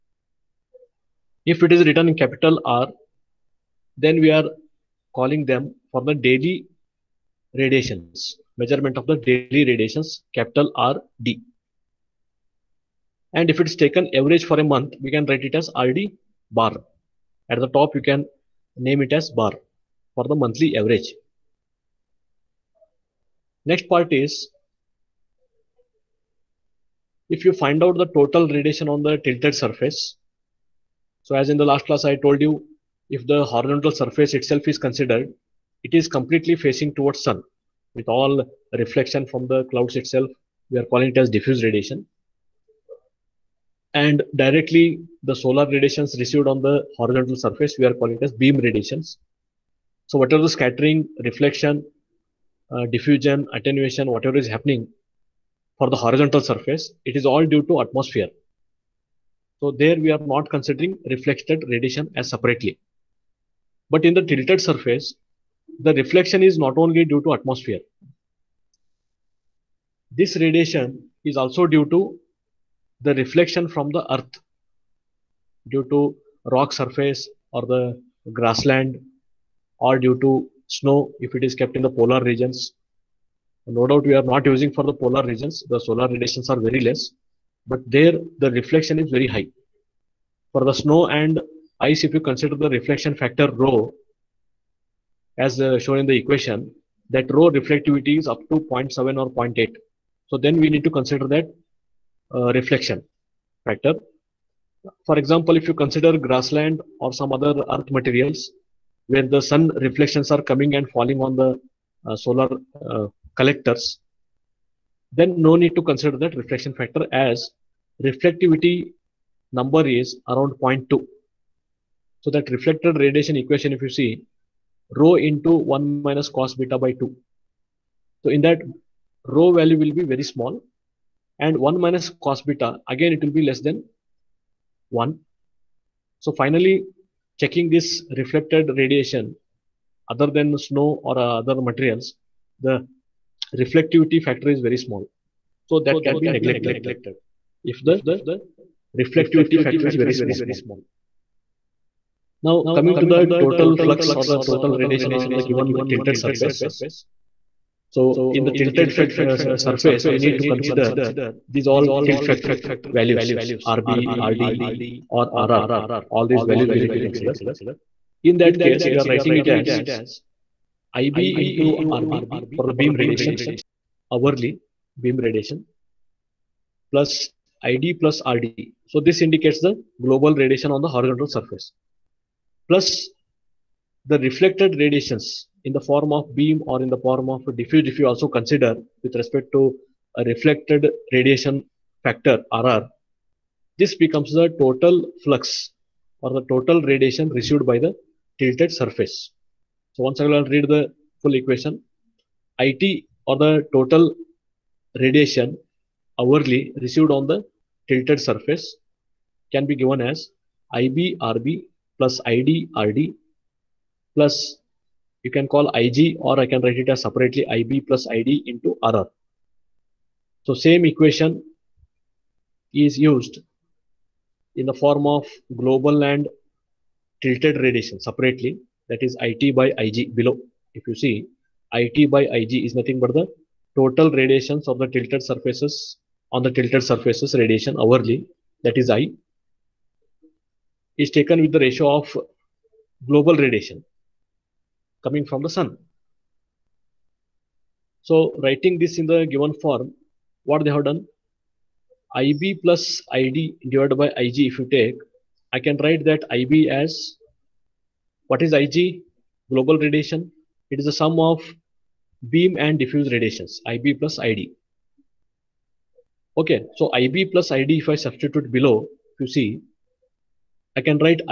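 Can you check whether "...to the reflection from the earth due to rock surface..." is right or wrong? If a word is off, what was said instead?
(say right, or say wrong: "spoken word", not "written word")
right.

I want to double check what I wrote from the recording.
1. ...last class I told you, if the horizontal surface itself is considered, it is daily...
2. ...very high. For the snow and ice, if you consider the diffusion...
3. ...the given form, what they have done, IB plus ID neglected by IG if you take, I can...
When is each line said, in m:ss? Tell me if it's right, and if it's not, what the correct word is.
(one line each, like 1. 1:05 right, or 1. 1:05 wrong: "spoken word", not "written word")
1. 0:31 wrong: "completely", not "daily"
2. 1:29 wrong: "reflection", not "diffusion"
3. 4:09 wrong: "divided", not "neglected".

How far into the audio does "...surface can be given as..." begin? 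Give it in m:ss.
3:28.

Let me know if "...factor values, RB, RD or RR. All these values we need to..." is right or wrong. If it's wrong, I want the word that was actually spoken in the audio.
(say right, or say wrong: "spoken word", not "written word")
right.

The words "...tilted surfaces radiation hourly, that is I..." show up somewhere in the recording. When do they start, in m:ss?
3:56.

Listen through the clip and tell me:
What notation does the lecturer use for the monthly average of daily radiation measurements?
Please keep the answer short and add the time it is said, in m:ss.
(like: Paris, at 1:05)
RD bar, at 0:15.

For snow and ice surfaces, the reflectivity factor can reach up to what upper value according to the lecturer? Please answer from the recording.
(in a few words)
0.8.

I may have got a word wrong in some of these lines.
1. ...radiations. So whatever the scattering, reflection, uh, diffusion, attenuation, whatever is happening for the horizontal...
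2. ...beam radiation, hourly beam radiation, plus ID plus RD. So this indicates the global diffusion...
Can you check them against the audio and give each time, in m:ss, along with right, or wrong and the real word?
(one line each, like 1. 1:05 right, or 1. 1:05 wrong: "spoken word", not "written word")
1. 0:48 right
2. 2:52 wrong: "radiation", not "diffusion".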